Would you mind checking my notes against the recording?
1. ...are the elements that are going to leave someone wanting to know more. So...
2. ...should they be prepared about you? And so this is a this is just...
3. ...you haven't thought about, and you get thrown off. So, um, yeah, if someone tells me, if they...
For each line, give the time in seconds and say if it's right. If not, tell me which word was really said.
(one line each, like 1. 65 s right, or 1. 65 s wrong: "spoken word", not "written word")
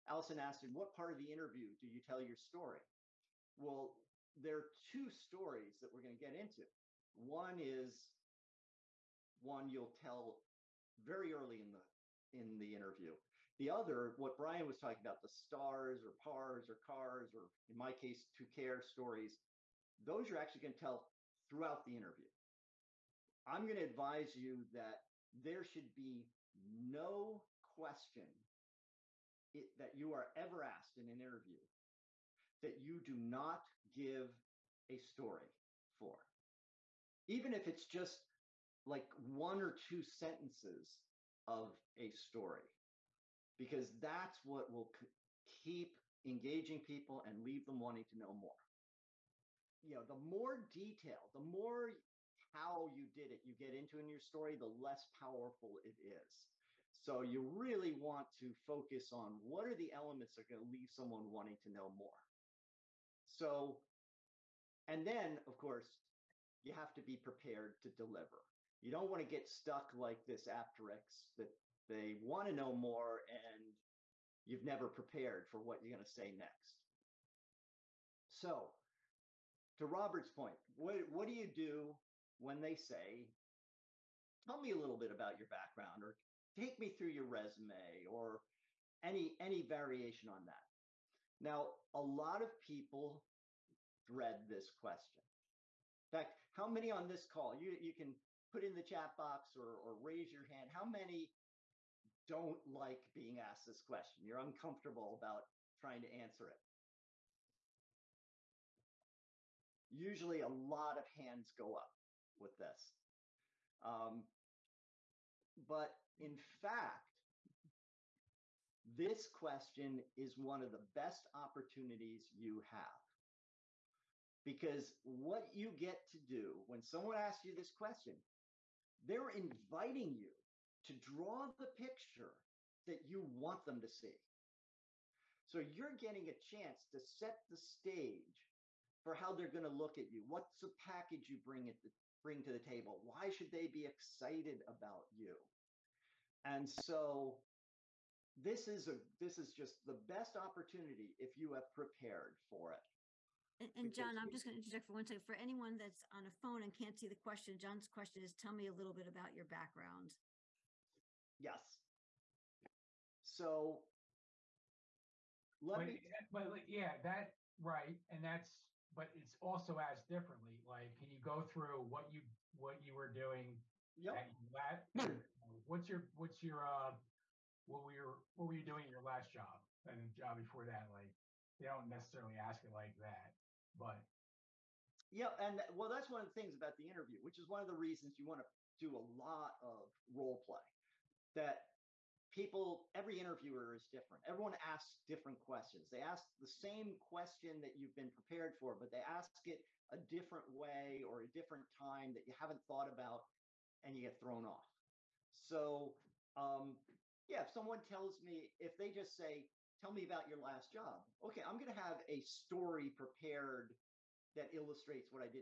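1. 59 s right
2. 143 s wrong: "excited", not "prepared"
3. 202 s right.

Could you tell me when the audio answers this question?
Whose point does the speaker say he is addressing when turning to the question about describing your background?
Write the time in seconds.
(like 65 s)
79 s.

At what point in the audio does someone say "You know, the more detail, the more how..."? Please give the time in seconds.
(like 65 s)
49 s.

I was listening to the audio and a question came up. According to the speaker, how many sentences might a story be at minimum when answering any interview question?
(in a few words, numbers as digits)
one or two.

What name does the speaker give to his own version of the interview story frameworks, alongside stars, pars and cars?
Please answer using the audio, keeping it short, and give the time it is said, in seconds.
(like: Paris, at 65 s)
to care stories, at 18 s.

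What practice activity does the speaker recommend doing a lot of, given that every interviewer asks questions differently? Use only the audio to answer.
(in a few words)
role play.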